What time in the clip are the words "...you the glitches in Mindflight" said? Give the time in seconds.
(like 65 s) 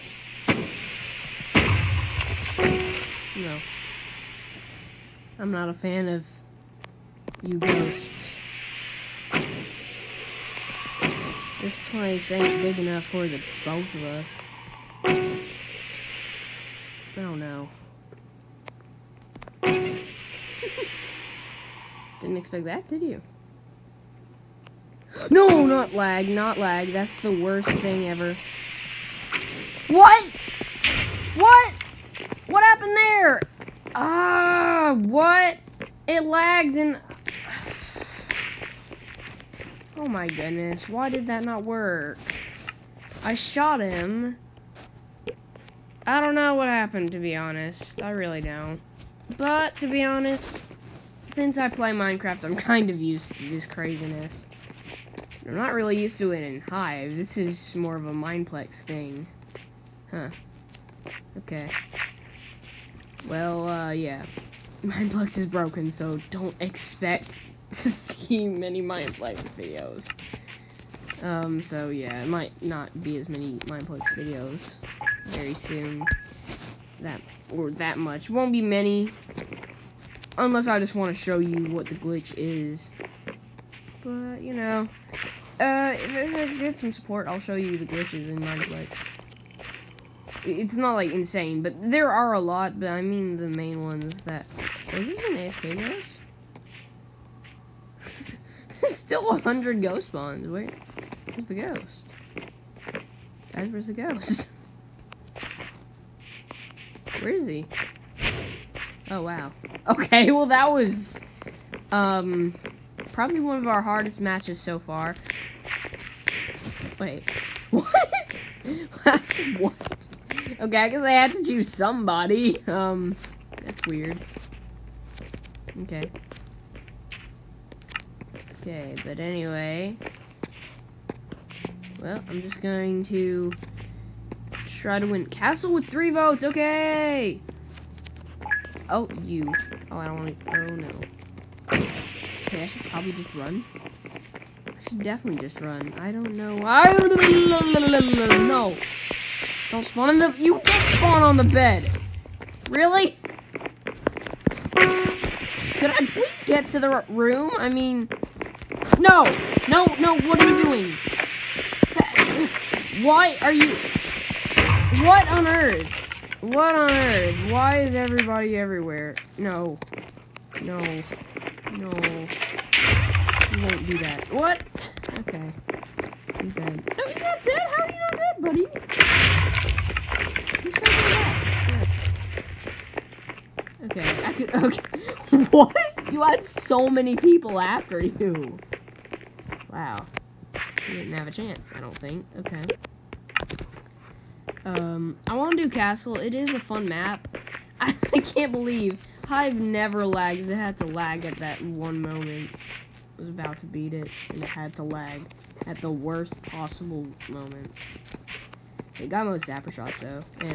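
87 s.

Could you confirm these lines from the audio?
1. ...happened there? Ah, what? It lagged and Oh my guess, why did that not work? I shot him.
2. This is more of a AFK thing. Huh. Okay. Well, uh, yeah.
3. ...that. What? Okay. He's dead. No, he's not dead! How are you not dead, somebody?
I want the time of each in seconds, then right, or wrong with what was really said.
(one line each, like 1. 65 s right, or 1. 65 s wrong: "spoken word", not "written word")
1. 32 s wrong: "goodness", not "guess"
2. 57 s wrong: "Mineplex", not "AFK"
3. 173 s wrong: "buddy", not "somebody".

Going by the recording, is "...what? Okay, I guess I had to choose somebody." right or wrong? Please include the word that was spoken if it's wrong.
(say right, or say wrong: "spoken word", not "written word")
right.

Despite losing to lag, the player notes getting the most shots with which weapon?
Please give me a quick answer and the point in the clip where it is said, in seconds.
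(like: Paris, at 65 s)
Zapper, at 209 s.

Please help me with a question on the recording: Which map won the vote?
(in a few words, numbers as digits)
Castle, 3 votes.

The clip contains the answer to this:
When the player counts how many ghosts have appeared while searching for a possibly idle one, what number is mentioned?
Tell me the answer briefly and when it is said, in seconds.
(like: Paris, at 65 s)
100, at 99 s.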